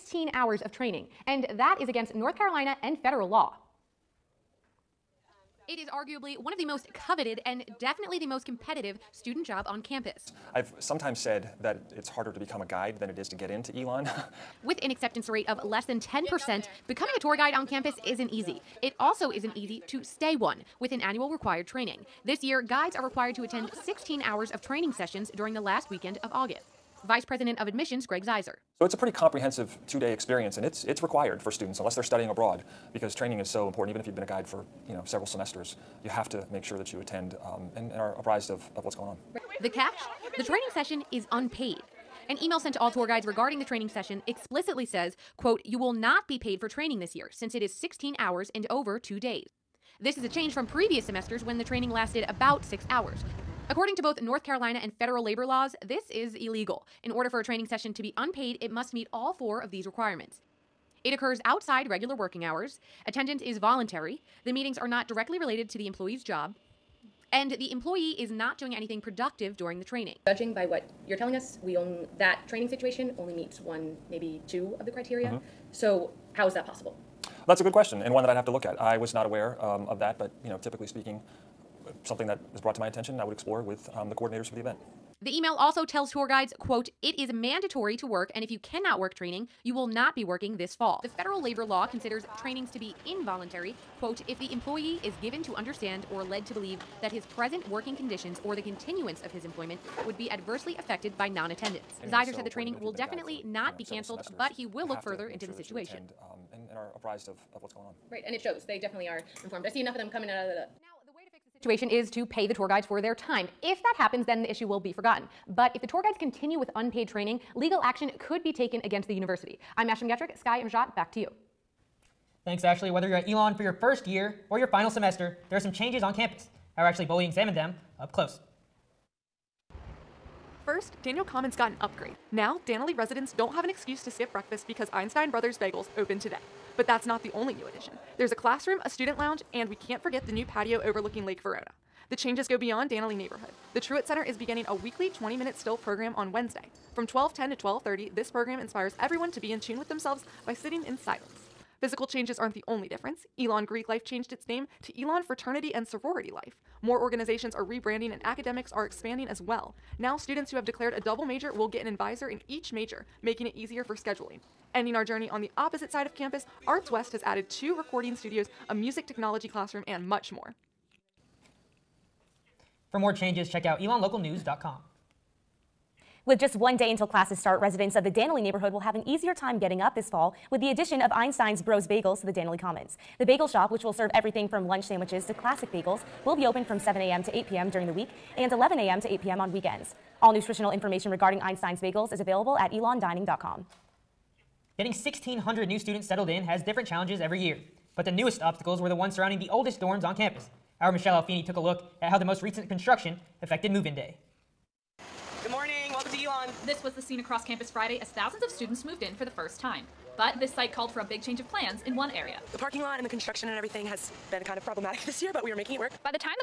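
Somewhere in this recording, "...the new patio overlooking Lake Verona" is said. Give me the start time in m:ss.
2:20.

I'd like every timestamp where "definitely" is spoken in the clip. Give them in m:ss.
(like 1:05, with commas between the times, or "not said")
0:07, 1:42, 1:48.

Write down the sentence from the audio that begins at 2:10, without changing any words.
First, Danley Commons got an upgrade.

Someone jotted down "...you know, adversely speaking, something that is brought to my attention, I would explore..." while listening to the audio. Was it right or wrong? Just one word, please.
wrong.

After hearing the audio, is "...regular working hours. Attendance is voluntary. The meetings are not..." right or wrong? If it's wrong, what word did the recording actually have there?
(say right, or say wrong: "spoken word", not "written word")
right.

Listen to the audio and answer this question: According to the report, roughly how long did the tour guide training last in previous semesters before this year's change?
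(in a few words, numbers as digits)
about 6 hours.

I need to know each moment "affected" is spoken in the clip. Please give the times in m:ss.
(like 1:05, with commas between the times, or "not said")
1:40, 3:23.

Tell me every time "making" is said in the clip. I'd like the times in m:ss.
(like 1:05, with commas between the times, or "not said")
2:43, 3:35.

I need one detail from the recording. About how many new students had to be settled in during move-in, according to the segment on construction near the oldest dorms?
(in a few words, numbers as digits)
1,600.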